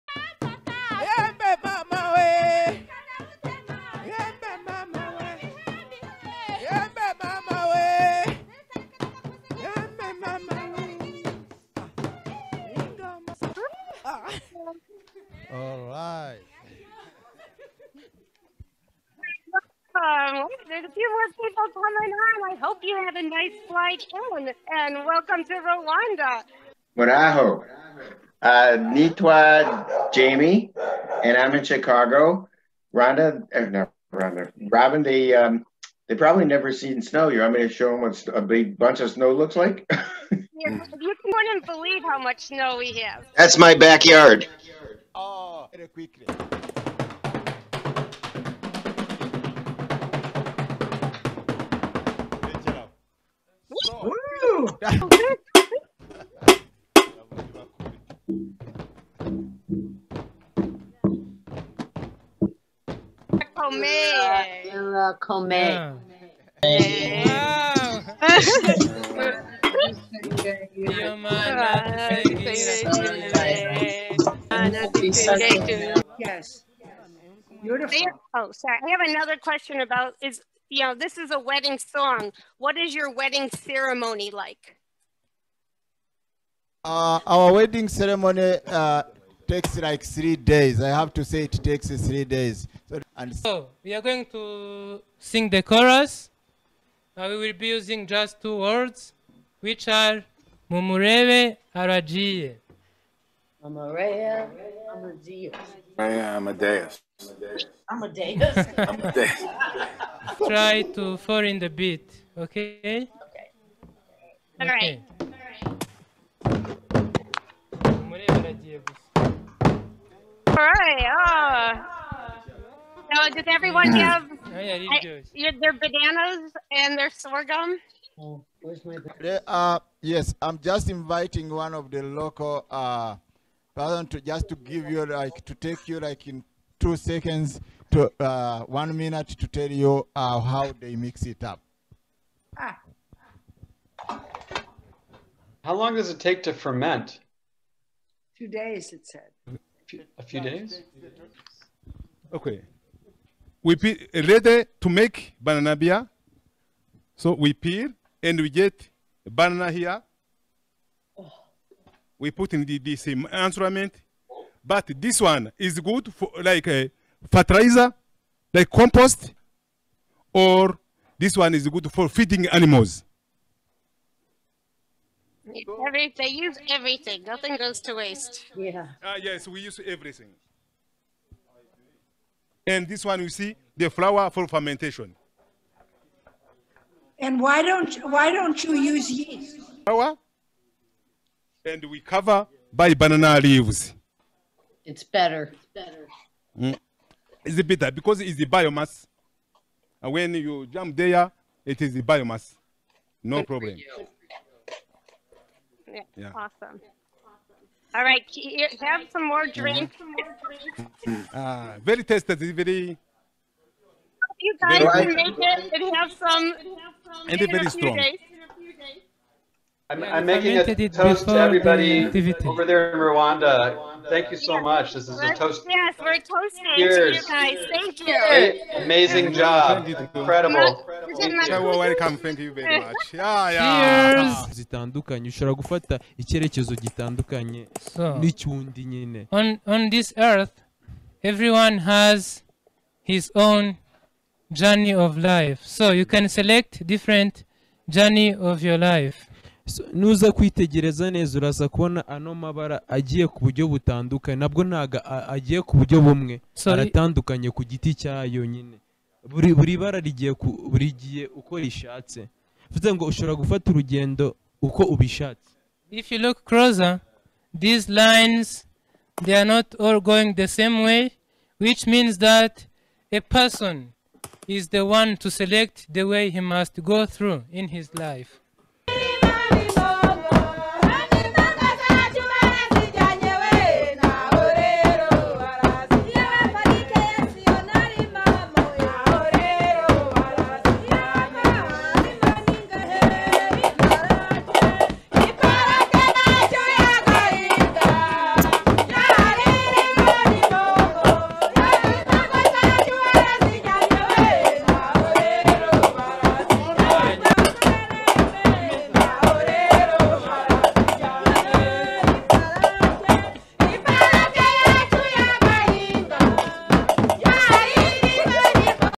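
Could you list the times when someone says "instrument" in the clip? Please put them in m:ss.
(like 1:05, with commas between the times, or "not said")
2:43.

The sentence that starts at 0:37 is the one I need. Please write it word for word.
You want me to show them what a big bunch of snow looks like?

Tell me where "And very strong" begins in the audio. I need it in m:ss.
3:37.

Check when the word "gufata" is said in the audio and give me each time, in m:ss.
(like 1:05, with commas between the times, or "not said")
3:55, 4:23.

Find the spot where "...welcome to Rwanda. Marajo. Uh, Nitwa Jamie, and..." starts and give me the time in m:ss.
0:25.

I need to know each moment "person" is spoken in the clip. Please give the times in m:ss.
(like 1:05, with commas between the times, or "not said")
2:13, 4:33.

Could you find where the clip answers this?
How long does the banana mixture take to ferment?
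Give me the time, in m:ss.
2:28.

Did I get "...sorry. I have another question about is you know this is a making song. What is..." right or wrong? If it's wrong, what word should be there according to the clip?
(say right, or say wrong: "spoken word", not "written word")
wrong: "wedding", not "making".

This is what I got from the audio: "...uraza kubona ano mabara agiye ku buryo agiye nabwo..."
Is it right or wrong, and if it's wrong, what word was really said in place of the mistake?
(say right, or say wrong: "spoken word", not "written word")
wrong: "butandukanye", not "agiye".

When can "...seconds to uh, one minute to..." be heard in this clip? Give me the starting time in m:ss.
2:16.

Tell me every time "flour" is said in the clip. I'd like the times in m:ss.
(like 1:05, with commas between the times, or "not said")
3:03, 3:09.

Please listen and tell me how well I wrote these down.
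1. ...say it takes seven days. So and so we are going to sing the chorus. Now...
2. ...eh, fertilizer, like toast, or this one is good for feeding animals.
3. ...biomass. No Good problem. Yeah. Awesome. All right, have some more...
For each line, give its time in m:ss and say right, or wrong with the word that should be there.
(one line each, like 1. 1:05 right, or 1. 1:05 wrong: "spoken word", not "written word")
1. 1:31 wrong: "three", not "seven"
2. 2:46 wrong: "compost", not "toast"
3. 3:22 right.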